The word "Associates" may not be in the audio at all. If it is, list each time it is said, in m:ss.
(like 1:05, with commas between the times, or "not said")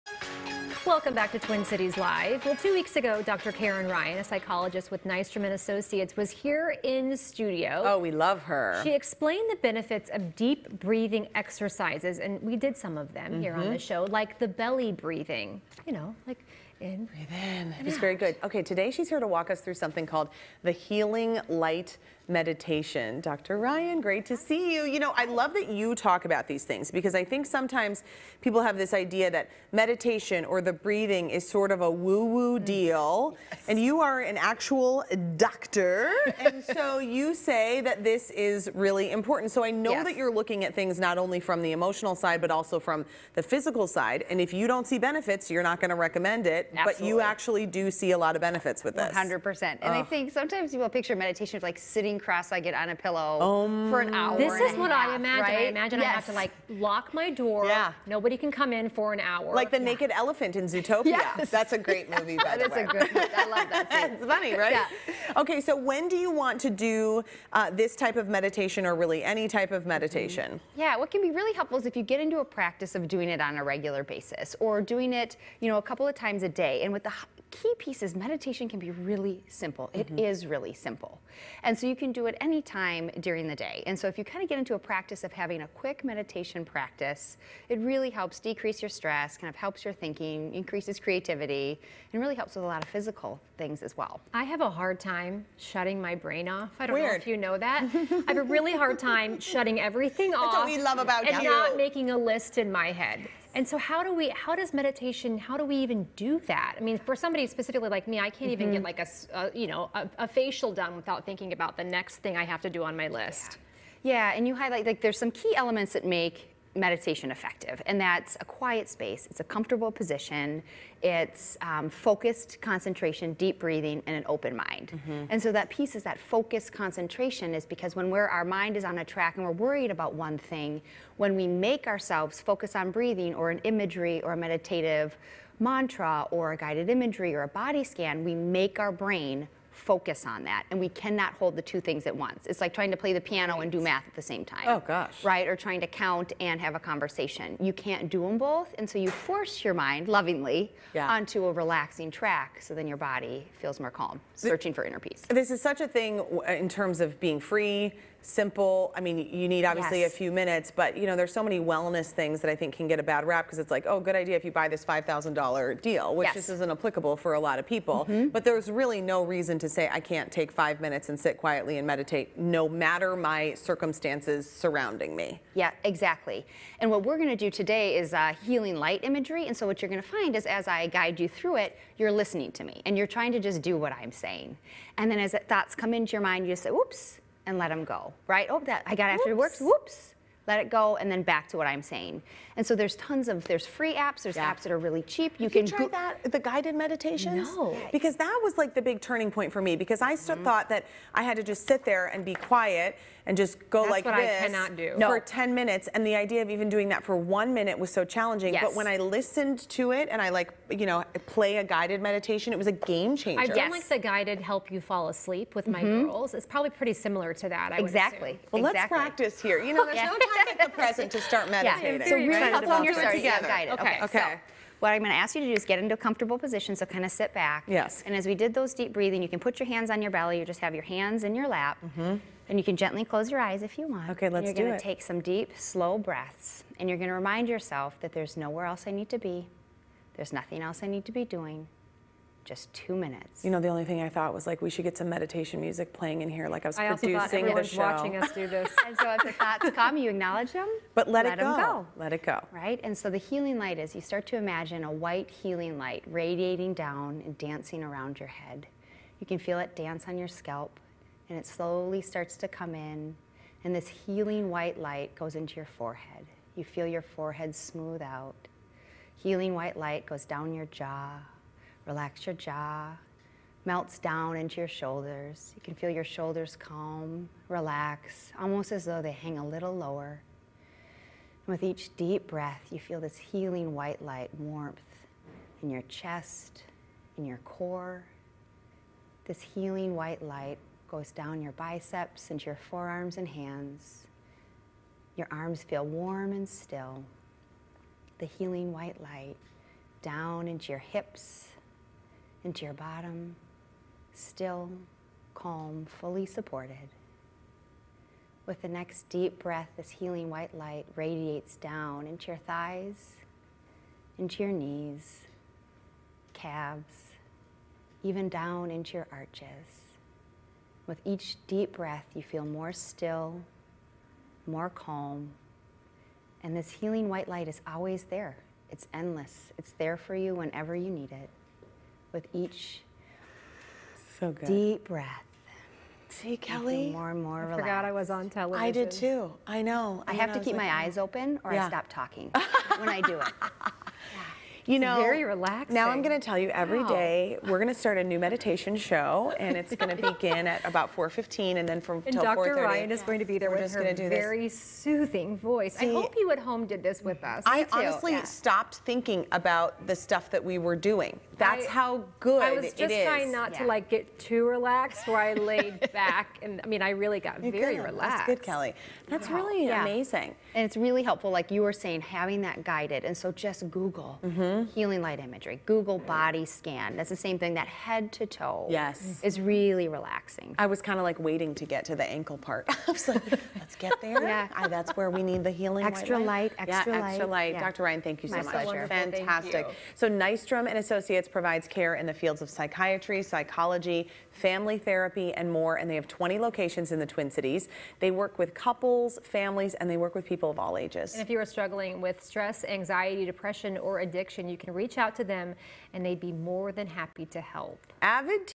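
0:05, 6:30.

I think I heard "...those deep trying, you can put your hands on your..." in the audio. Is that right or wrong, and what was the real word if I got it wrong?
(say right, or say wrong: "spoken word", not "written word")
wrong: "breathing", not "trying".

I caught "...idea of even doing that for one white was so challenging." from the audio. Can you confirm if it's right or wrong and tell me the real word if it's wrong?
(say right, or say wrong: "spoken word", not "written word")
wrong: "minute", not "white".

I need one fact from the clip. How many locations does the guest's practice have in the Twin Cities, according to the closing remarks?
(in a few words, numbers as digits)
20.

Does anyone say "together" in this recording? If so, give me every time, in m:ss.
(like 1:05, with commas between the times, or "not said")
3:42.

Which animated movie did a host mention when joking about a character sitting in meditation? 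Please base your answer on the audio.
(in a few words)
Zootopia.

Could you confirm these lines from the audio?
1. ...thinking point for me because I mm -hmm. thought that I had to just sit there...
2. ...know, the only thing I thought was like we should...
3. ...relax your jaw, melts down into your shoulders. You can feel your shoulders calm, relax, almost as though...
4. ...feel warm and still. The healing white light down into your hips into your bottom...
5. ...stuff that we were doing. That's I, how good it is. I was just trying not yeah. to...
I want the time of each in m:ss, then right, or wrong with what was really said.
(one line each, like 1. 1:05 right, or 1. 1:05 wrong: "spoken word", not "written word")
1. 3:19 wrong: "turning", not "thinking"
2. 4:03 right
3. 4:31 right
4. 4:55 right
5. 5:59 right.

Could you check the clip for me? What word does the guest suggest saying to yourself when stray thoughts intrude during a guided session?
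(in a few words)
oops.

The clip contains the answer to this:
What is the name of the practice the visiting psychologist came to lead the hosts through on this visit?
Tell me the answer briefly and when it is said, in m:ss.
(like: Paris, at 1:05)
Healing Light Meditation, at 0:20.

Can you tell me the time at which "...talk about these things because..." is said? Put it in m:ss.
0:25.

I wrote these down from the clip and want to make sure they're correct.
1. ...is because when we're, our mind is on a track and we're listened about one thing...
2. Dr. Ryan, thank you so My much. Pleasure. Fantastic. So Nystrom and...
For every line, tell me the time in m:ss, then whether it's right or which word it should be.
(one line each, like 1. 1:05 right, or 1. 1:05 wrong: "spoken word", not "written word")
1. 2:07 wrong: "worried", not "listened"
2. 6:27 right.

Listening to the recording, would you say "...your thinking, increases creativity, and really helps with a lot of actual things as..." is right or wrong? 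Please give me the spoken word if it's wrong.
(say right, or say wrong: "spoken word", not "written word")
wrong: "physical", not "actual".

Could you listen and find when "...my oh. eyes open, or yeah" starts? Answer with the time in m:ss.
5:40.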